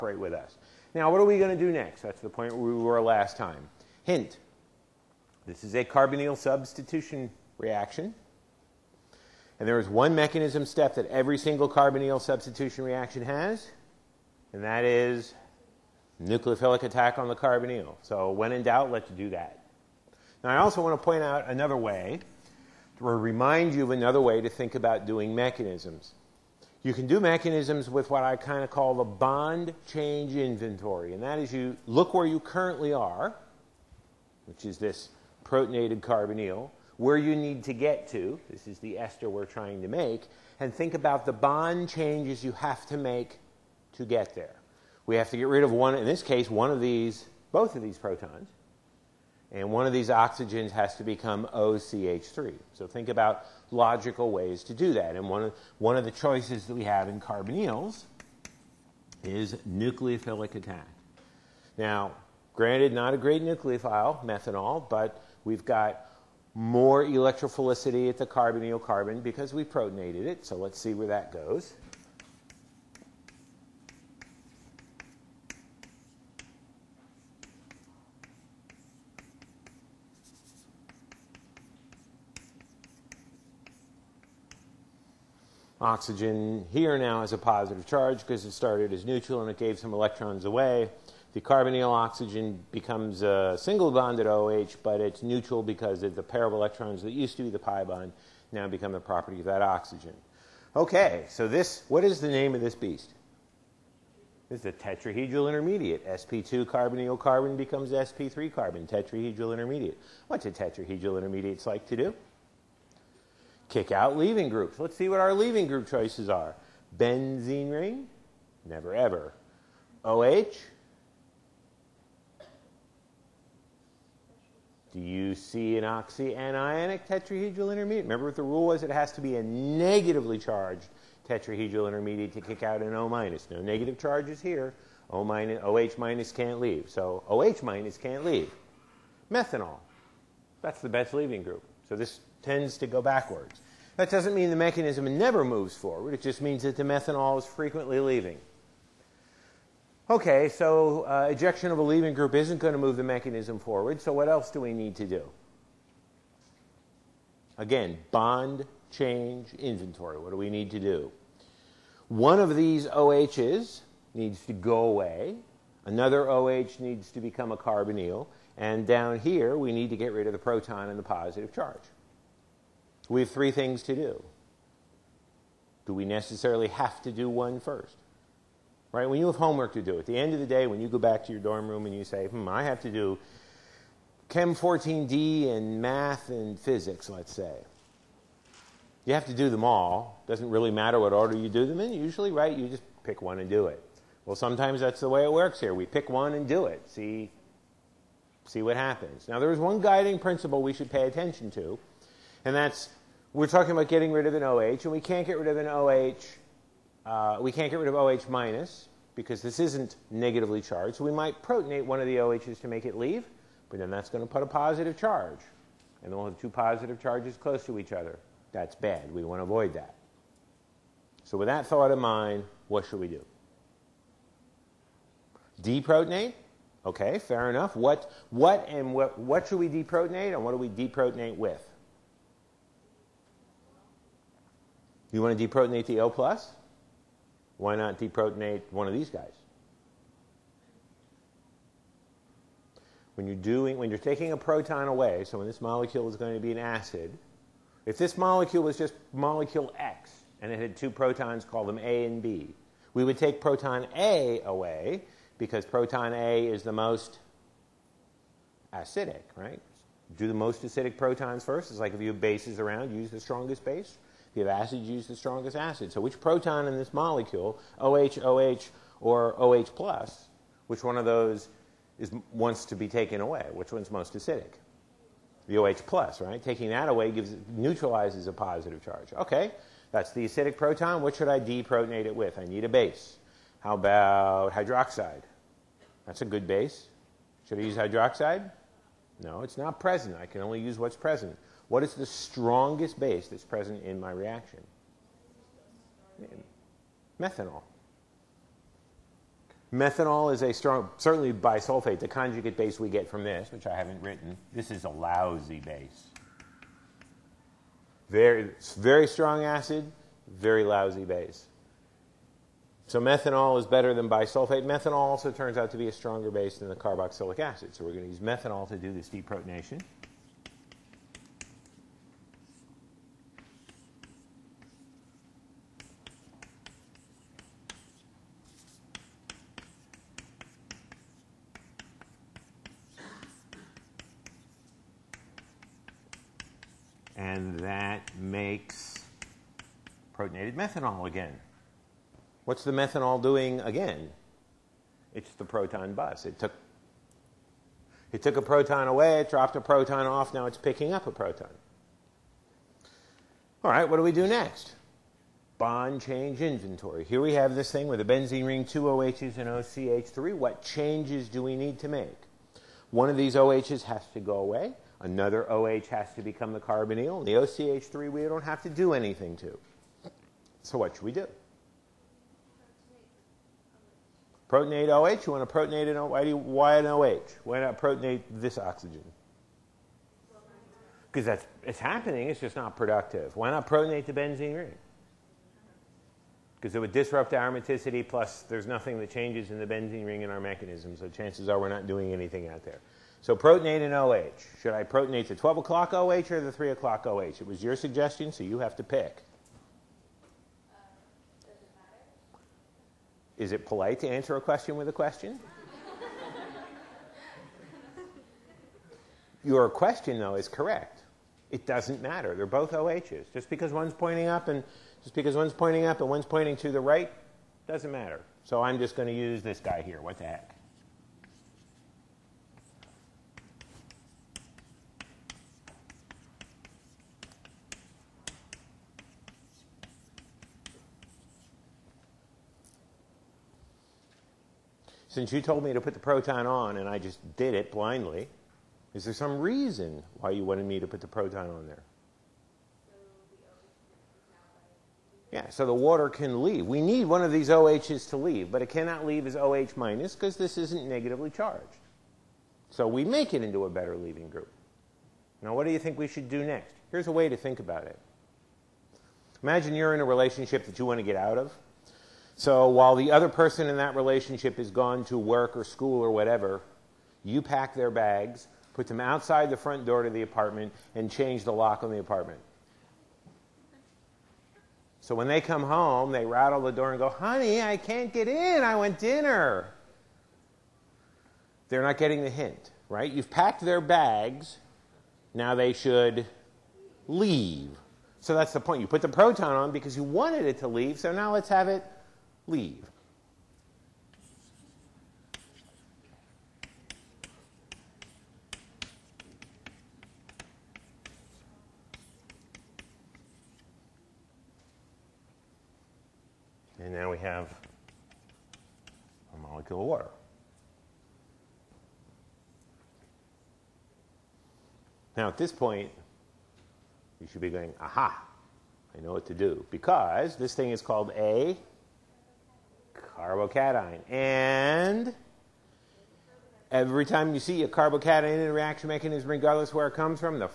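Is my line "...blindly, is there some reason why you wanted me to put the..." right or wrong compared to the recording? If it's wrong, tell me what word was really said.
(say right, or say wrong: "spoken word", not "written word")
right.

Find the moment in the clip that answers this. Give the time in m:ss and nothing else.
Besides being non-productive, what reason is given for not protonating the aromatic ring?
6:26.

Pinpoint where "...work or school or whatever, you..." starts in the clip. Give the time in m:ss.
7:45.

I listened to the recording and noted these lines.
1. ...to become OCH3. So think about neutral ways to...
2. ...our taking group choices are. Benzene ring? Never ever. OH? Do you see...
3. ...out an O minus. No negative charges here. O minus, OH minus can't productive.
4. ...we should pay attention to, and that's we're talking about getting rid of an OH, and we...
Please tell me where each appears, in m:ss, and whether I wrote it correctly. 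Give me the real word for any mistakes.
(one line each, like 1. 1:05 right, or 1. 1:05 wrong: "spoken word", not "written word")
1. 0:50 wrong: "logical", not "neutral"
2. 1:55 wrong: "leaving", not "taking"
3. 2:12 wrong: "leave", not "productive"
4. 3:20 right.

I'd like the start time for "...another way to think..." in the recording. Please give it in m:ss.
0:23.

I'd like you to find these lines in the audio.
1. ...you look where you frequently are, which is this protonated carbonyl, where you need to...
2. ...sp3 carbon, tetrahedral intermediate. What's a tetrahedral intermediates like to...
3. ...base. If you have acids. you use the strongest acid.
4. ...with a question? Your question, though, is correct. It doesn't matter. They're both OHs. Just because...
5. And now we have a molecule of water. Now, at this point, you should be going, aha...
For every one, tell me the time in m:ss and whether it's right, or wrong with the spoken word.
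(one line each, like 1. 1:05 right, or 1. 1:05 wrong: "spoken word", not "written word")
1. 0:31 wrong: "currently", not "frequently"
2. 1:47 right
3. 4:23 right
4. 6:44 right
5. 8:26 right.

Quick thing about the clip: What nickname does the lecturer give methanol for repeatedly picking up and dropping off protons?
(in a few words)
Proton bus.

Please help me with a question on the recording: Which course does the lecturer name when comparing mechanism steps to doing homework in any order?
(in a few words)
Chem 14D.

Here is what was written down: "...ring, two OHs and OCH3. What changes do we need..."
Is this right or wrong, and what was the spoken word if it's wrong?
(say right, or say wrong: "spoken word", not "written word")
right.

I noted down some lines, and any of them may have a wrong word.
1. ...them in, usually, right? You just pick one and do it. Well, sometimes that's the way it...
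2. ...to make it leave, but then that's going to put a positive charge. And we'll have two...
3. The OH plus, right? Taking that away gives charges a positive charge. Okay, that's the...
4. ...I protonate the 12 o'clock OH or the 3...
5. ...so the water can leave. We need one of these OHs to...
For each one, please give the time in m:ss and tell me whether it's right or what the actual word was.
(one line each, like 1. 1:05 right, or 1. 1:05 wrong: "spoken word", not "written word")
1. 3:11 right
2. 3:32 right
3. 4:35 wrong: "neutralizes", not "charges"
4. 6:34 right
5. 7:25 right.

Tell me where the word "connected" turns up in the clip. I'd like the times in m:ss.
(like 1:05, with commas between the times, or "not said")
not said.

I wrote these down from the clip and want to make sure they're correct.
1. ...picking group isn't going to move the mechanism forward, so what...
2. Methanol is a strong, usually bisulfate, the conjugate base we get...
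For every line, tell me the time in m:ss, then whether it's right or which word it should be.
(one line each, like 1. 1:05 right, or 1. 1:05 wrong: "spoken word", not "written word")
1. 2:31 wrong: "leaving", not "picking"
2. 4:59 wrong: "certainly", not "usually".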